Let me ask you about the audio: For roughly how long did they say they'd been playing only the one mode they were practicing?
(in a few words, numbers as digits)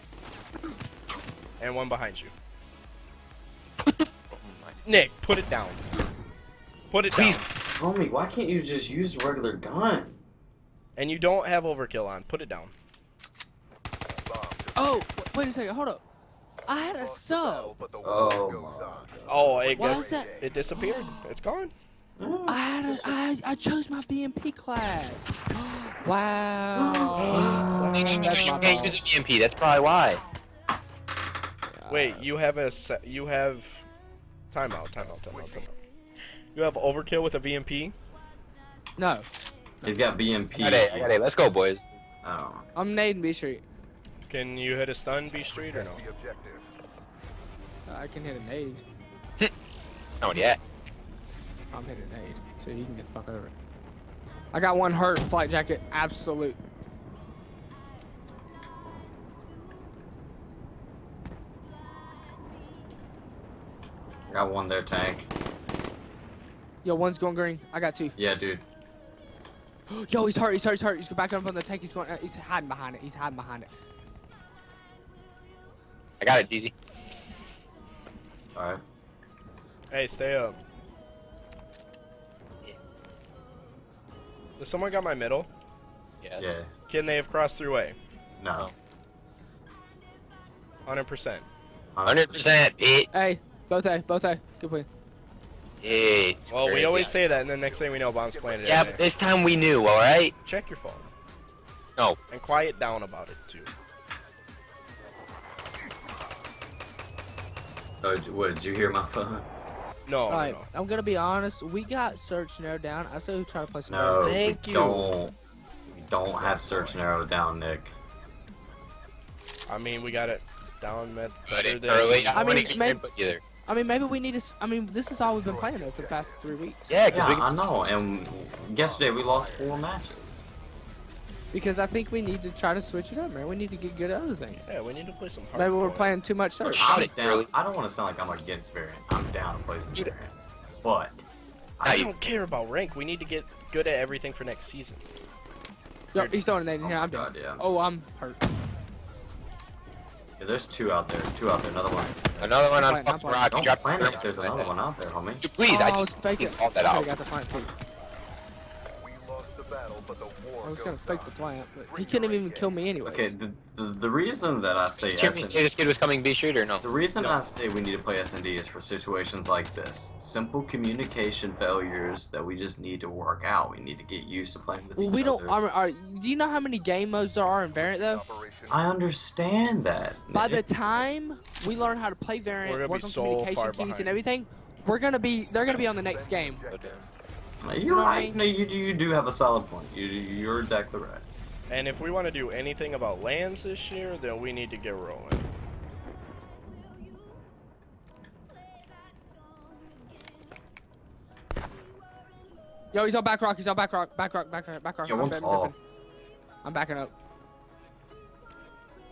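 3 weeks.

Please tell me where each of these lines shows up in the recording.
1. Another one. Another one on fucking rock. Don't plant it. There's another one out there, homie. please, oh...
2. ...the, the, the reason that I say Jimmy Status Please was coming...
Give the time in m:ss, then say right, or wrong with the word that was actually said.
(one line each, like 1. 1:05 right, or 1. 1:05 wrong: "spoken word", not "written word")
1. 2:31 right
2. 2:43 wrong: "Kid", not "Please".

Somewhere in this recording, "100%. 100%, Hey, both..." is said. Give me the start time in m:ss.
1:30.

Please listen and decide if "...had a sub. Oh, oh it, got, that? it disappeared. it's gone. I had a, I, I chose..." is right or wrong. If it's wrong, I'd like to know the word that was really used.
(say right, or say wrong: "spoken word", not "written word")
right.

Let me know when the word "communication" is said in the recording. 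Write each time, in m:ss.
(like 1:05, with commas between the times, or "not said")
2:50, 3:03.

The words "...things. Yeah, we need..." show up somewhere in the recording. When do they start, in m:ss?
2:14.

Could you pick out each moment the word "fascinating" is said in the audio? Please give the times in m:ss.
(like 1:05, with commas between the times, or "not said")
not said.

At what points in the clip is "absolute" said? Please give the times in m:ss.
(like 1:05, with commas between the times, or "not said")
0:55.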